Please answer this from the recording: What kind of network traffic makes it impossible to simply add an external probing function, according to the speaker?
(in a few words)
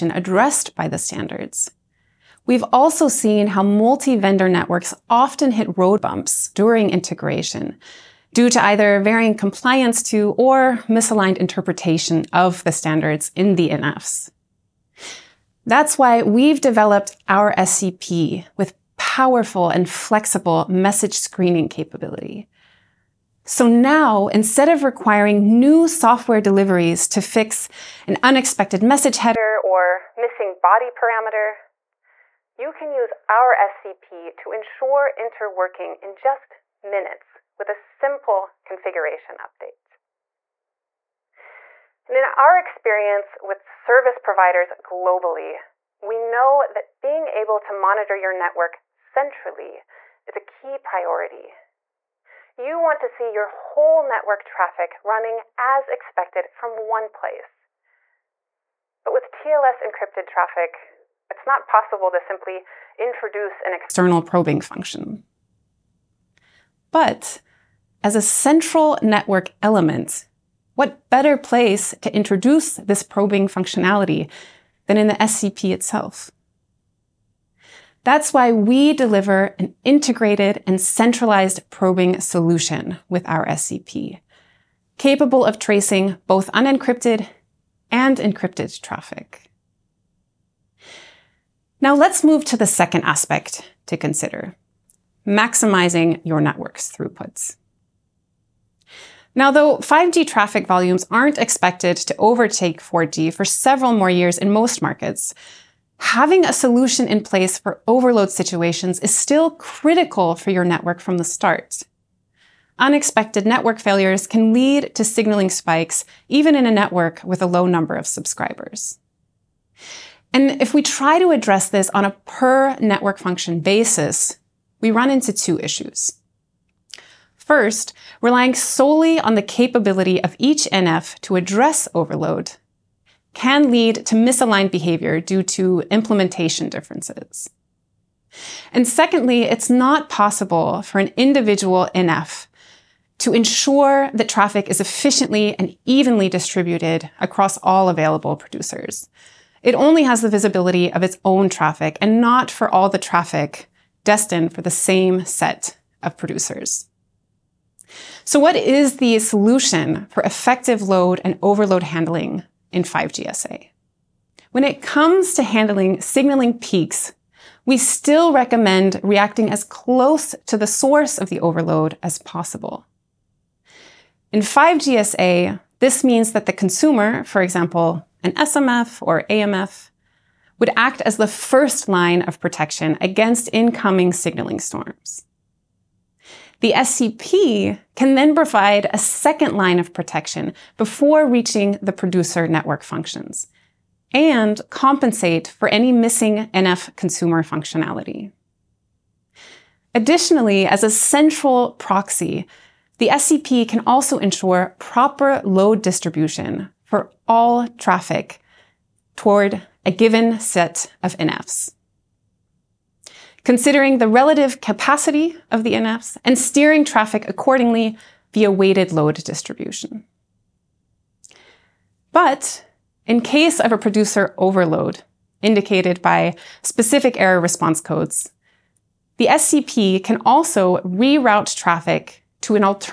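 TLS encrypted traffic.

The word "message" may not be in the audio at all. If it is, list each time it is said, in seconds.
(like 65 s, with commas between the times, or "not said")
20 s, 28 s.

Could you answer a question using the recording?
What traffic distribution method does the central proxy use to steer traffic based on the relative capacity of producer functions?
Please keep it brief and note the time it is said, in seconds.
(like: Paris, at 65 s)
weighted load distribution, at 218 s.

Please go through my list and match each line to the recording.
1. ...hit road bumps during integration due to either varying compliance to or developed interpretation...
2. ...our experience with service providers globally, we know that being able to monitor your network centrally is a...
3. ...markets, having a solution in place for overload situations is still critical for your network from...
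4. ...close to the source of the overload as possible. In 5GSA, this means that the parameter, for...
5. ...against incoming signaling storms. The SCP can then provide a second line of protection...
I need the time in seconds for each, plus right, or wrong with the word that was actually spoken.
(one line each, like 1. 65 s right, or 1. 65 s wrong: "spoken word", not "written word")
1. 5 s wrong: "misaligned", not "developed"
2. 42 s right
3. 104 s right
4. 169 s wrong: "consumer", not "parameter"
5. 183 s right.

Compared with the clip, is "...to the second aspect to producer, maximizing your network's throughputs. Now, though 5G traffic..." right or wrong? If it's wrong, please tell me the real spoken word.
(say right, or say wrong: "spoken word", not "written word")
wrong: "consider", not "producer".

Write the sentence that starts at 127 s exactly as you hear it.
First, relying solely on the capability of each NF to address overload can lead to misaligned behavior due to implementation differences.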